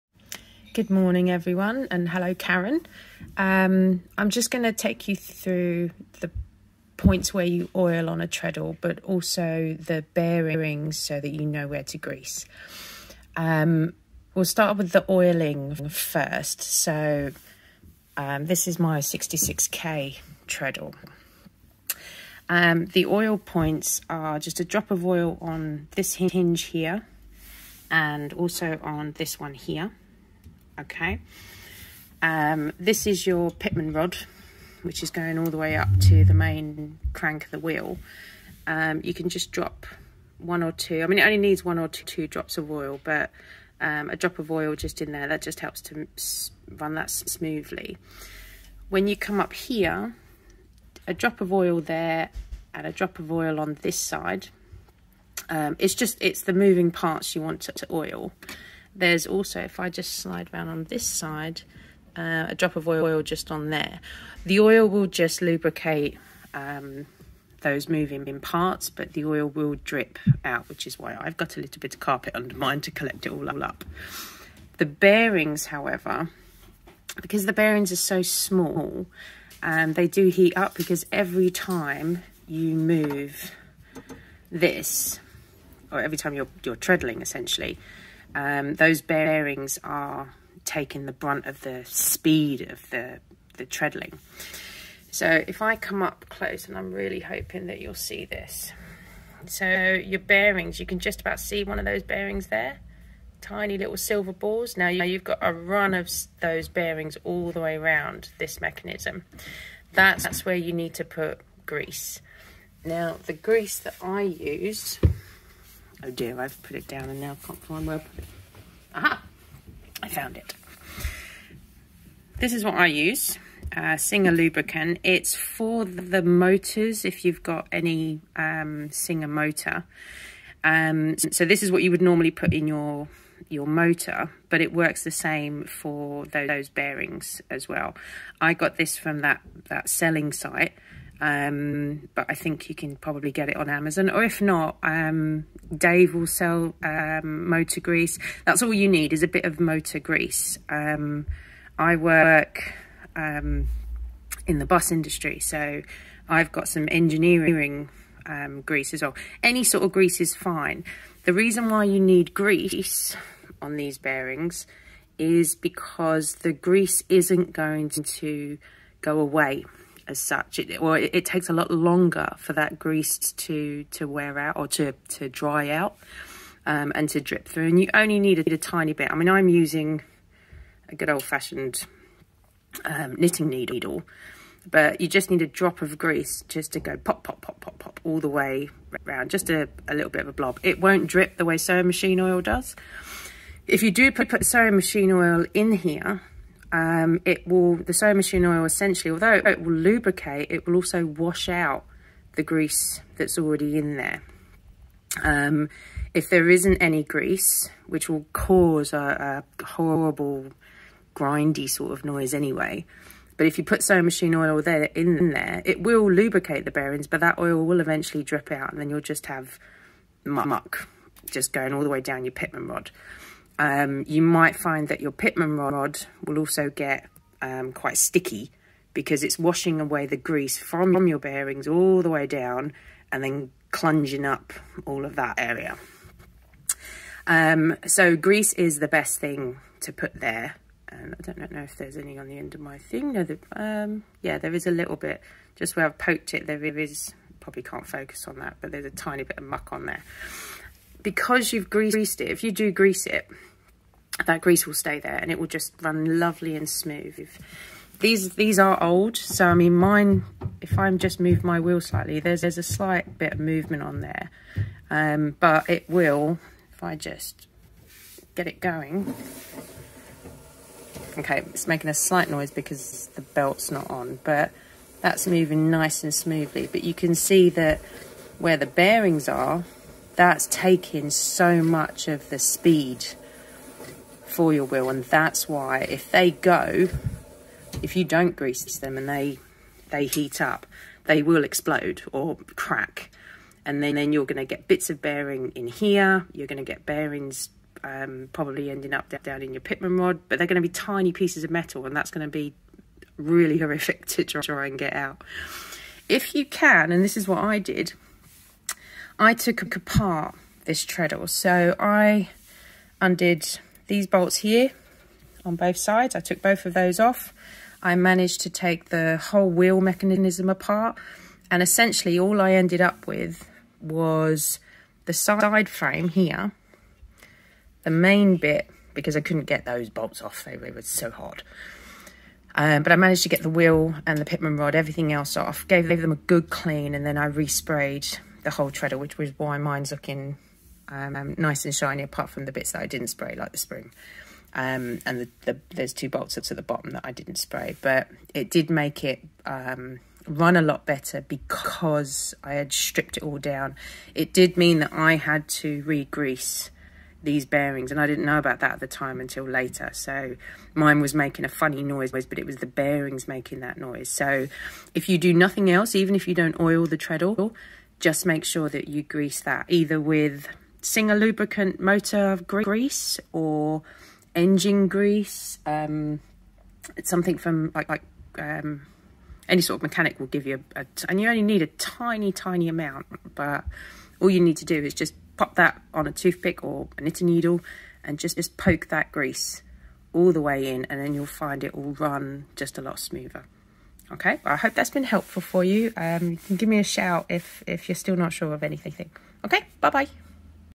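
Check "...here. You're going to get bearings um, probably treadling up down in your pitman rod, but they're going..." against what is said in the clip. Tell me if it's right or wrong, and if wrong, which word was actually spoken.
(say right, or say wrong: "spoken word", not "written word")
wrong: "ending", not "treadling".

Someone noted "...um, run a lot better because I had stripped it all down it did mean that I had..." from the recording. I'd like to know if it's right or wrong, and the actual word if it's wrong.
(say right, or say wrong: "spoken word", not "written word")
right.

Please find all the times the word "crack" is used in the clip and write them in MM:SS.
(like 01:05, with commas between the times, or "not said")
04:52.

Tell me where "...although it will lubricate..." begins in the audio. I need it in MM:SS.
03:19.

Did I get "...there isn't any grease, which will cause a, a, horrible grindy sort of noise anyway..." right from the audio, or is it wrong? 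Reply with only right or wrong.
right.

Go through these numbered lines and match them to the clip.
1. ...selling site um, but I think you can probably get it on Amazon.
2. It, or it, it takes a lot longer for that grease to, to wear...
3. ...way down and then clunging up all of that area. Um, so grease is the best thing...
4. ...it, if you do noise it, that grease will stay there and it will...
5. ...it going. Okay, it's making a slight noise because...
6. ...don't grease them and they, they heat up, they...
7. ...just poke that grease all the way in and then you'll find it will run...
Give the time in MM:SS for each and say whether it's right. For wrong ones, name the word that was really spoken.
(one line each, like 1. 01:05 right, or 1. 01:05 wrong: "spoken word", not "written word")
1. 02:19 right
2. 02:50 right
3. 03:52 right
4. 04:12 wrong: "grease", not "noise"
5. 04:28 right
6. 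04:48 right
7. 06:28 right.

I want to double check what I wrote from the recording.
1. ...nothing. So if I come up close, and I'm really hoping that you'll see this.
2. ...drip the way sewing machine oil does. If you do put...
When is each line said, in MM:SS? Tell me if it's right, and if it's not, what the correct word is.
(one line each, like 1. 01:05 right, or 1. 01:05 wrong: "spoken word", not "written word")
1. 01:33 wrong: "treadling", not "nothing"
2. 03:11 right.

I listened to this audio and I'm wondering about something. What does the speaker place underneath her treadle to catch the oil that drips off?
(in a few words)
carpet.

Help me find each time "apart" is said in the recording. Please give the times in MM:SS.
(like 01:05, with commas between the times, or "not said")
05:09, 05:20, 05:42.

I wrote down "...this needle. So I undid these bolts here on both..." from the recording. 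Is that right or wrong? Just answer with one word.
wrong.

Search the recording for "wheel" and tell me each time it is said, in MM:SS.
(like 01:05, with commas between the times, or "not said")
00:37, 04:21, 04:44, 05:19, 05:33.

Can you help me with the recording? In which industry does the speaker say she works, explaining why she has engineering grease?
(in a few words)
bus industry.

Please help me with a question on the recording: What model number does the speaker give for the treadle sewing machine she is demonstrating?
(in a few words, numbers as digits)
66K.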